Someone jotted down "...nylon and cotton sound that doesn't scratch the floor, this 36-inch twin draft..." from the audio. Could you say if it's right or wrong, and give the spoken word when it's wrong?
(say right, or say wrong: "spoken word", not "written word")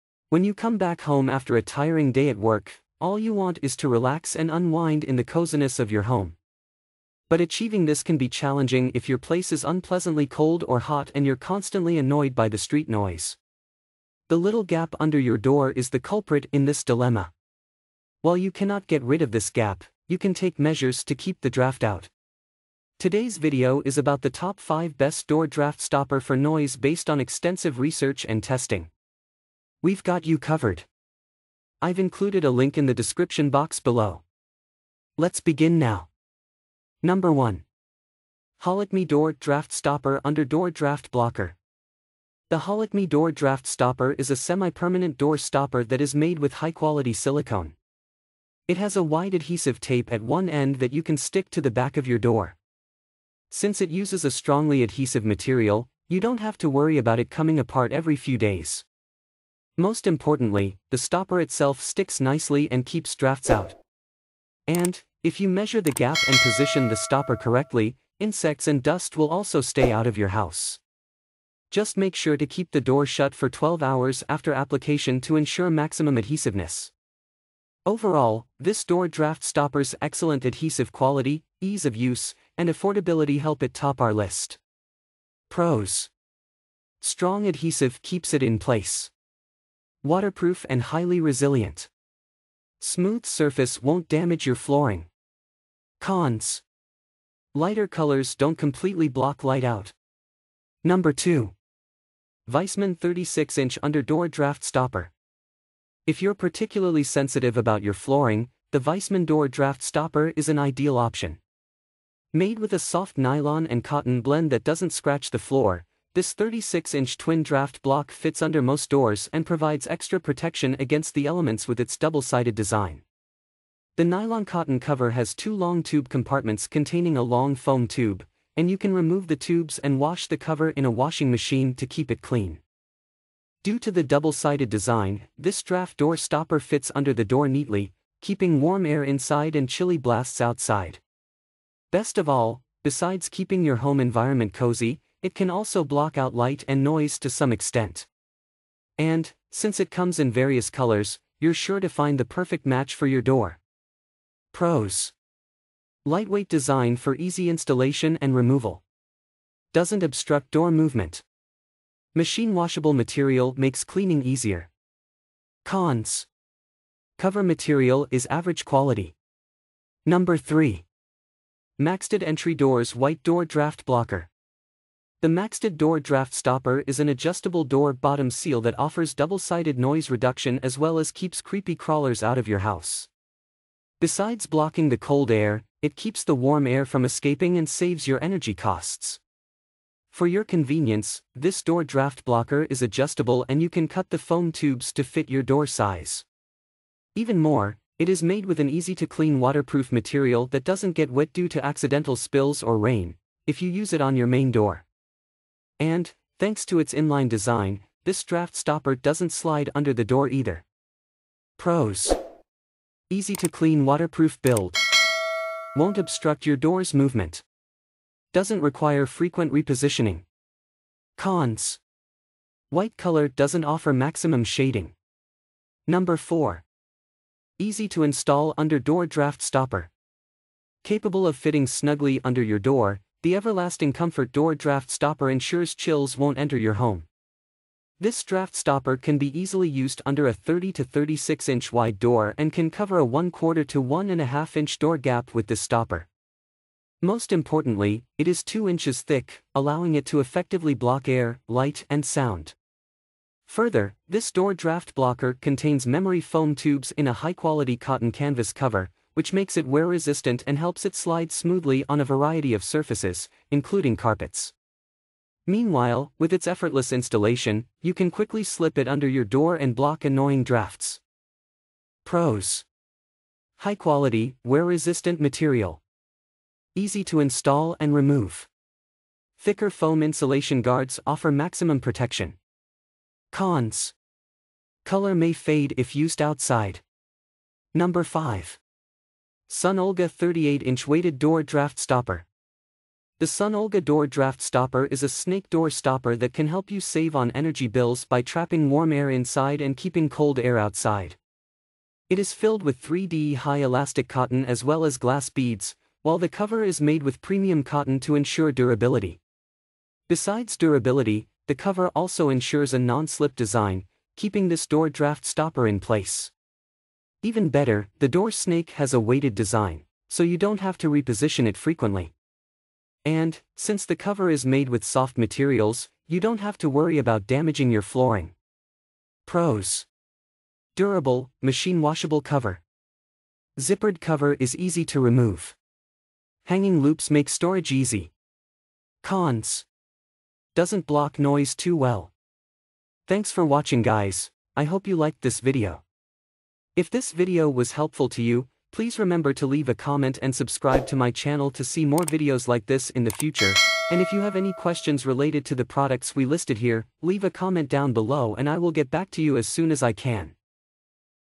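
wrong: "blend", not "sound".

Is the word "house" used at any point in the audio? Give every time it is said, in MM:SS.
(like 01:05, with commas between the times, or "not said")
01:10, 03:02.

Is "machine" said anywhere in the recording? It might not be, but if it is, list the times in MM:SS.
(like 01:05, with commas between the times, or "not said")
02:11, 02:42, 05:31.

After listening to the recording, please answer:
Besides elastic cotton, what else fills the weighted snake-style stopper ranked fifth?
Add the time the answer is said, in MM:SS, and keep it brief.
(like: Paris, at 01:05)
glass beads, at 05:04.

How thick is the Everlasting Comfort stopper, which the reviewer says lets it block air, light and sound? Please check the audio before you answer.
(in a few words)
2 inches.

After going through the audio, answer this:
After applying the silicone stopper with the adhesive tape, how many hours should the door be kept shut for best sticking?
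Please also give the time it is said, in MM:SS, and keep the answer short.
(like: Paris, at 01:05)
12, at 01:13.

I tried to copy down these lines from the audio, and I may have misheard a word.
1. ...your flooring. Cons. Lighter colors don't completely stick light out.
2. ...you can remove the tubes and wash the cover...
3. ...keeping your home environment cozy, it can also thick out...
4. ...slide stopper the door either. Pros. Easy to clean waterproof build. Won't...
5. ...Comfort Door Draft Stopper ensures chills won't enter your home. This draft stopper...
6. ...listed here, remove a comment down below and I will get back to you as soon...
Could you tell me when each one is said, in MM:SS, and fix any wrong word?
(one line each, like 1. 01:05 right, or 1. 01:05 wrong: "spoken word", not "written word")
1. 01:34 wrong: "block", not "stick"
2. 02:08 right
3. 02:23 wrong: "block", not "thick"
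4. 03:29 wrong: "under", not "stopper"
5. 03:53 right
6. 05:56 wrong: "leave", not "remove".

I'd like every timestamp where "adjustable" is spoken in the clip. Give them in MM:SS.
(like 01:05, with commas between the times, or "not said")
02:57, 03:12.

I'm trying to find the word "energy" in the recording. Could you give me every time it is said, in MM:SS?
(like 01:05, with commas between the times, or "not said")
03:08, 04:57.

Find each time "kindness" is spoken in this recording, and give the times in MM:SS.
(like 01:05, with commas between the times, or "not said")
not said.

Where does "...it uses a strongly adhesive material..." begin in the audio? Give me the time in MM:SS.
00:53.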